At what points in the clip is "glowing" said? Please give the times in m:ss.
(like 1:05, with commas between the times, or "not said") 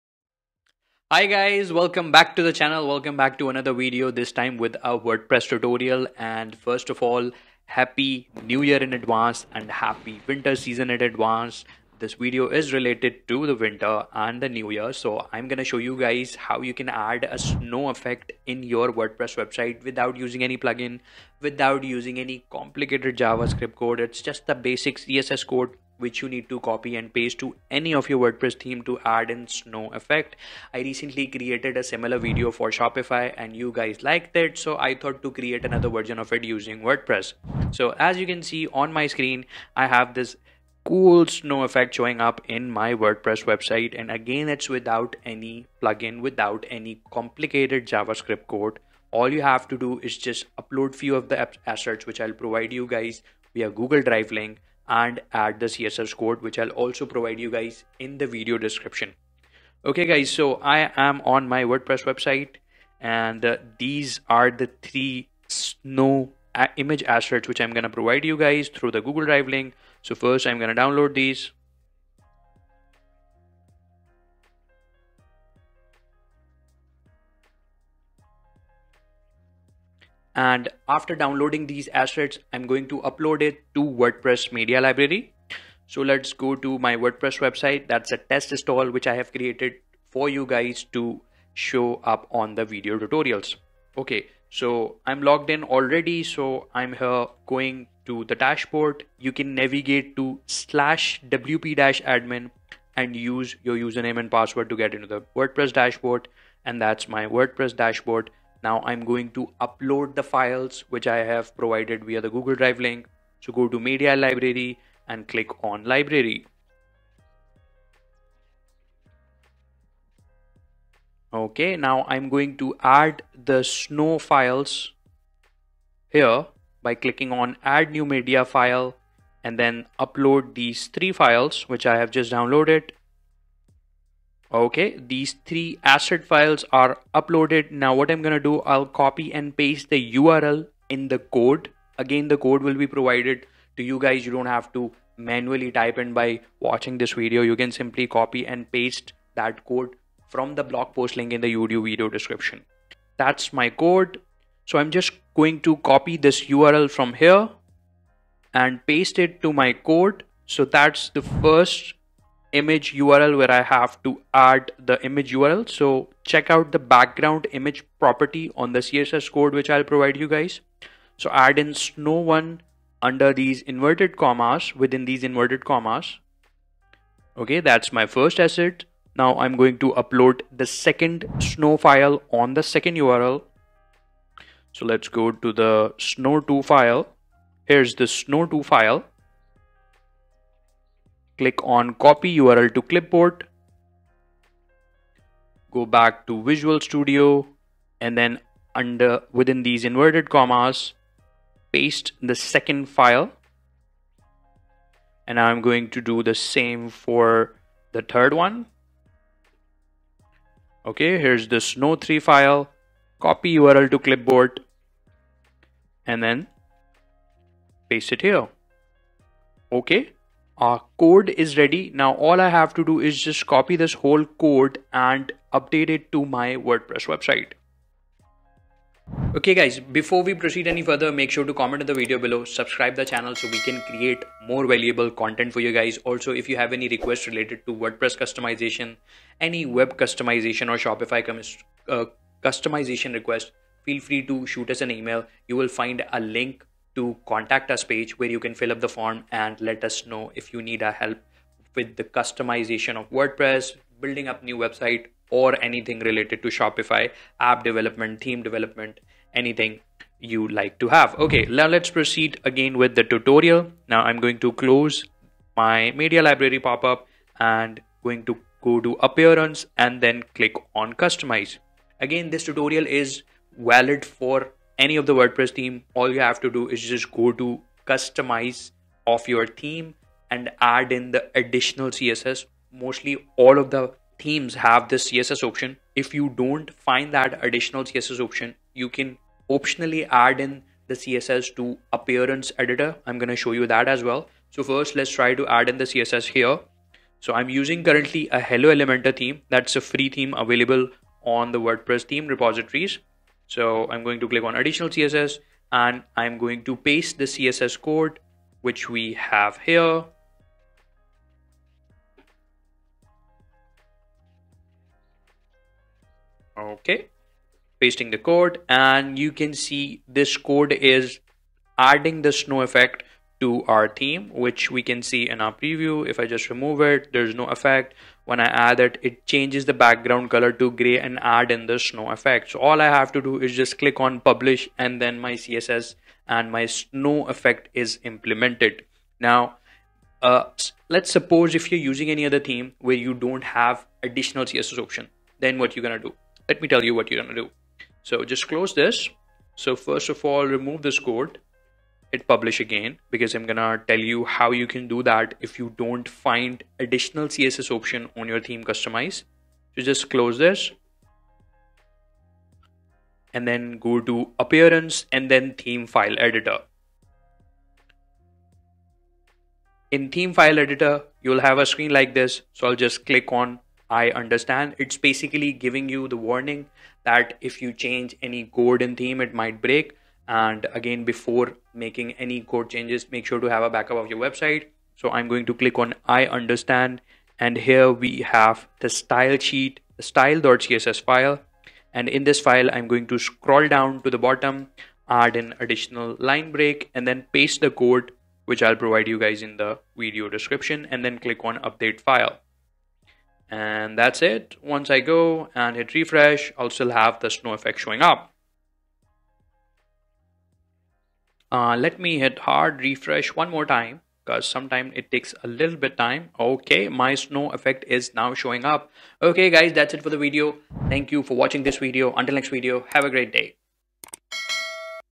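not said.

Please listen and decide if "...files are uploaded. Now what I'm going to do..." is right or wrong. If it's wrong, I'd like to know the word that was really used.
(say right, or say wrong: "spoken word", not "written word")
right.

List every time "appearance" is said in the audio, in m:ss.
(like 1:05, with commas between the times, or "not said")
4:29, 4:51, 6:04.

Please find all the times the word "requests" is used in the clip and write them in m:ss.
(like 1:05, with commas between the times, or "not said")
3:56, 4:03.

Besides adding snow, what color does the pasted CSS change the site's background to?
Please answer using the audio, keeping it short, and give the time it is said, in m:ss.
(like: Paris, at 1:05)
gray, at 5:30.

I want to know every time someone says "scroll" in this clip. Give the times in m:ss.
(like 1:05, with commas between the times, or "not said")
6:33.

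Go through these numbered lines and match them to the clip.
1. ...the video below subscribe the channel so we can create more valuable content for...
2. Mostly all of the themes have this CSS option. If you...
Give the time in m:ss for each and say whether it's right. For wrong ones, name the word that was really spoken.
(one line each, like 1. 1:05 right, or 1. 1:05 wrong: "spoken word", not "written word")
1. 3:51 right
2. 4:42 right.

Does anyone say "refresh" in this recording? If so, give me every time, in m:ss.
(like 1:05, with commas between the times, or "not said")
6:46, 6:52.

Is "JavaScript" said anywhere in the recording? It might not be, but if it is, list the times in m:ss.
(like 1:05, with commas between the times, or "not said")
0:23, 0:47.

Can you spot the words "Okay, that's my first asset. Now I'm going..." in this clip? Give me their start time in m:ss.
2:57.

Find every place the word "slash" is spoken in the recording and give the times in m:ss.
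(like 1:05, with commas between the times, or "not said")
1:40.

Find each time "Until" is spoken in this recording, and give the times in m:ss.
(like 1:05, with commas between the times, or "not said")
7:02.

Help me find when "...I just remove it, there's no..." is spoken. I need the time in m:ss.
5:26.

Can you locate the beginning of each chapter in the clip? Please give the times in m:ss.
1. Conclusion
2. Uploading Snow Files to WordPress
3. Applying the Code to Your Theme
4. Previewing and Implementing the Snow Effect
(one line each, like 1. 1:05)
1. 6:45
2. 1:40
3. 2:25
4. 5:18.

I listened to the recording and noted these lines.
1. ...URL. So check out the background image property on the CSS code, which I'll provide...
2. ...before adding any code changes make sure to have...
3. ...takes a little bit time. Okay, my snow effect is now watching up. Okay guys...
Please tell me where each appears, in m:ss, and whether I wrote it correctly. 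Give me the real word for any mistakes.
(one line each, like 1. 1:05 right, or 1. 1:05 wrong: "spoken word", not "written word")
1. 2:45 right
2. 6:21 wrong: "making", not "adding"
3. 6:55 wrong: "showing", not "watching".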